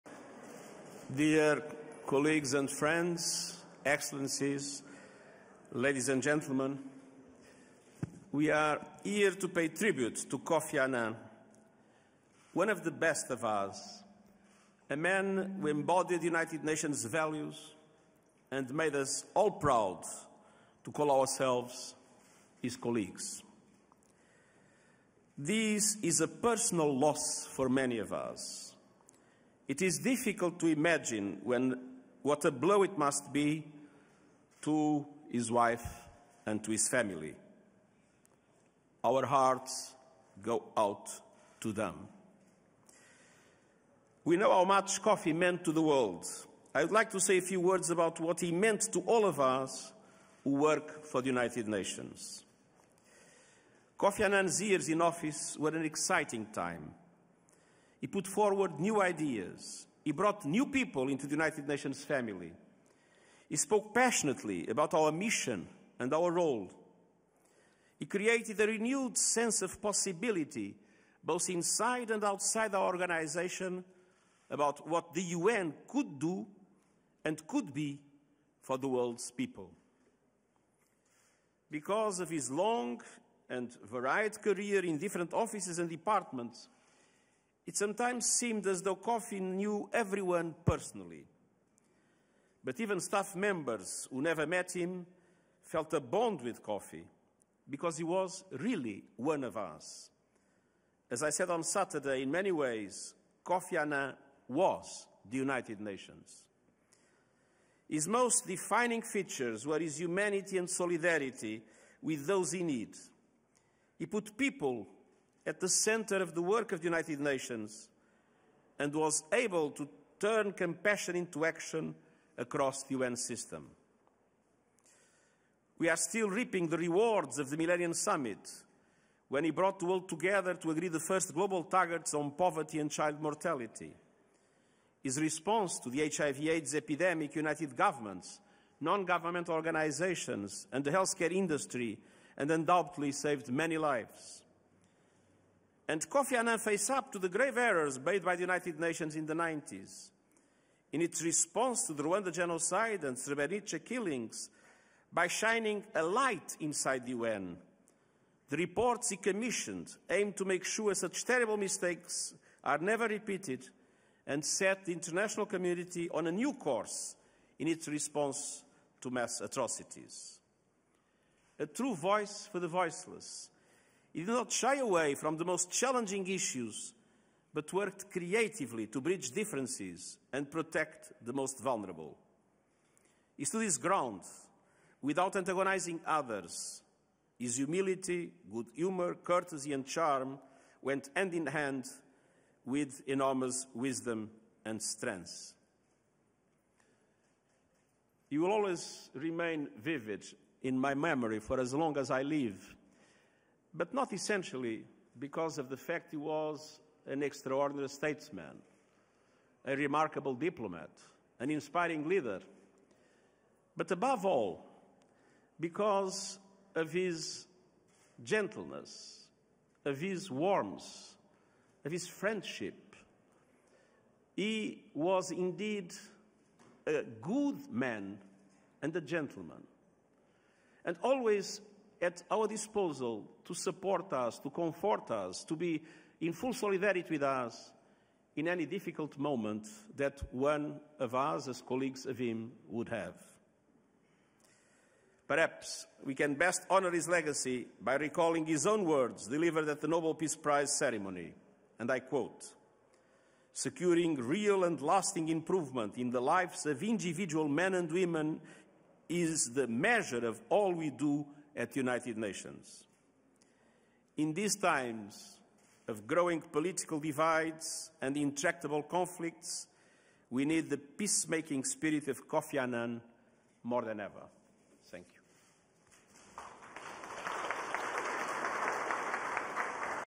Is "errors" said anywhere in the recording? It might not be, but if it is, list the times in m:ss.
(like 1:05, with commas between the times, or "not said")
2:27.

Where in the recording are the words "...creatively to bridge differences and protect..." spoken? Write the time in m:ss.
2:58.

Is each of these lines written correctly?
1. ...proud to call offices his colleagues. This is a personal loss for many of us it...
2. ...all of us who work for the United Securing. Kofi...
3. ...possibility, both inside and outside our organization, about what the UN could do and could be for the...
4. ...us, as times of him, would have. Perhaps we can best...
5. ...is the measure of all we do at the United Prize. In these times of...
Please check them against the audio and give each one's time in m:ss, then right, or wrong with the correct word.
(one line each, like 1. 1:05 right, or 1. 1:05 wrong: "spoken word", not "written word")
1. 0:19 wrong: "ourselves", not "offices"
2. 0:49 wrong: "Nations", not "Securing"
3. 1:09 right
4. 4:01 wrong: "colleagues", not "times"
5. 4:19 wrong: "Nations", not "Prize".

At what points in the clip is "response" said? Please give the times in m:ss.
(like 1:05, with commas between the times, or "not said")
2:15, 2:31, 2:47.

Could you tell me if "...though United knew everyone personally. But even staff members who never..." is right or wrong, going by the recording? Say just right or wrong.
wrong.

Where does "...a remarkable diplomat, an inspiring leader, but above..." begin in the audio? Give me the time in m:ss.
3:29.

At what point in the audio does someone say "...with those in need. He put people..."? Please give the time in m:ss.
1:52.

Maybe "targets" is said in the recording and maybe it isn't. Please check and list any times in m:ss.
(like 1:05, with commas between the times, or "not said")
2:11.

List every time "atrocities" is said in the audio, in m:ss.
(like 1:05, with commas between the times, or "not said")
2:49.